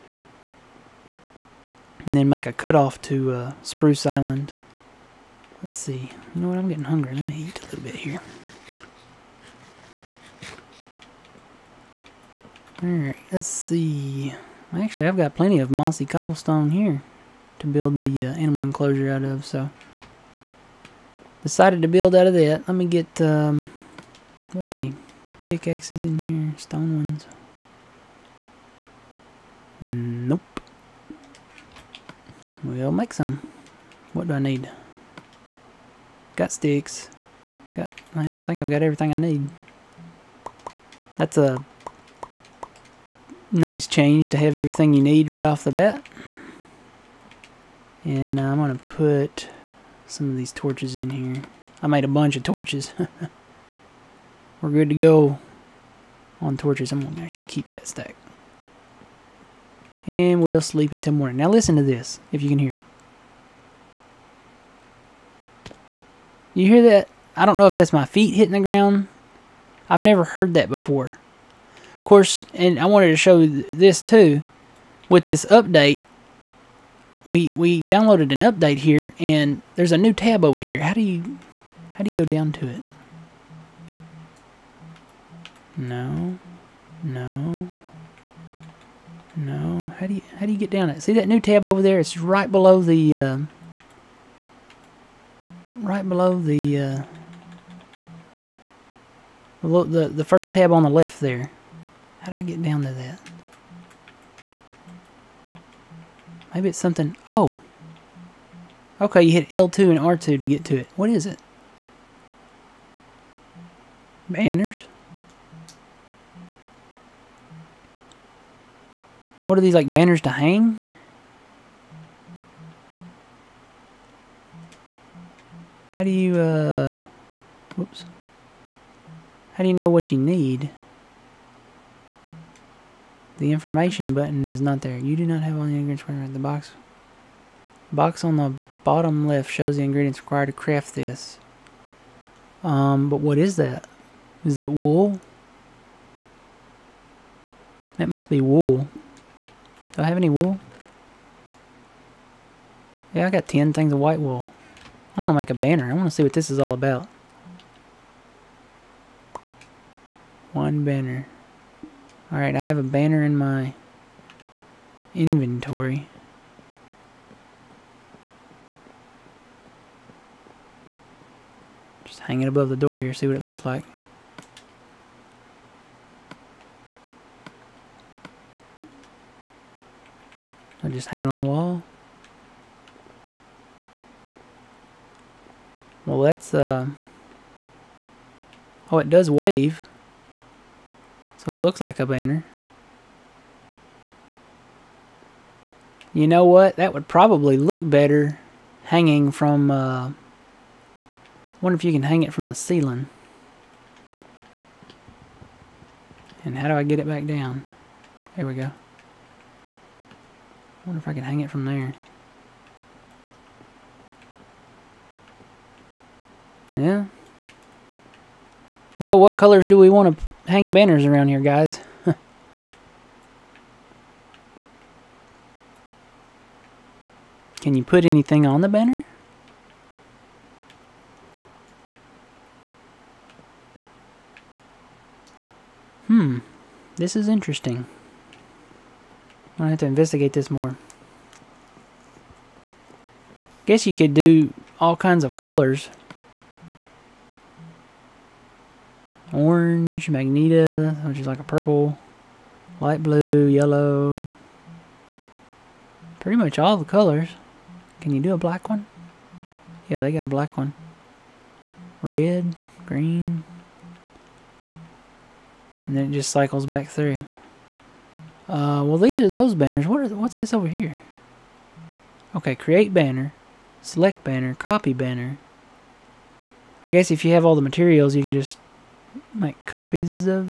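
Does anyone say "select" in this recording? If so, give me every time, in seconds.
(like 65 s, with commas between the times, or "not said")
273 s.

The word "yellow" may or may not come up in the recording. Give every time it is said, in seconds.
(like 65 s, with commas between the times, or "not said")
253 s.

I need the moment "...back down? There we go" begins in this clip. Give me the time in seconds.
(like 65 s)
207 s.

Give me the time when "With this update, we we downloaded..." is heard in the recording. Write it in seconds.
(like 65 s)
75 s.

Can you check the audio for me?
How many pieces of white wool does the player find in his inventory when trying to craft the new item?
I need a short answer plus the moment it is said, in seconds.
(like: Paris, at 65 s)
10, at 153 s.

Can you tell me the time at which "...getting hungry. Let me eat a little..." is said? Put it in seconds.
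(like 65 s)
6 s.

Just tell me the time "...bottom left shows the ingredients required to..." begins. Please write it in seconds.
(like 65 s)
138 s.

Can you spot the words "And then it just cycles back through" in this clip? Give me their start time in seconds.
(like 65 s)
265 s.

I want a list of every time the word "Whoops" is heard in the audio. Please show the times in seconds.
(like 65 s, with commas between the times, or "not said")
127 s.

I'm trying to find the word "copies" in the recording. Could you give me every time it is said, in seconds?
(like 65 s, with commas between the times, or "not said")
279 s.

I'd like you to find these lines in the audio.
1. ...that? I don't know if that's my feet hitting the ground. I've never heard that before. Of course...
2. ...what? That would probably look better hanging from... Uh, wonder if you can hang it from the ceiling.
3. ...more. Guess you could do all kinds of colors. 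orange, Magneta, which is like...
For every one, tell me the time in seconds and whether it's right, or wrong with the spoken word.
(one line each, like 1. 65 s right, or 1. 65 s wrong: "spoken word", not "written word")
1. 66 s right
2. 196 s right
3. 240 s right.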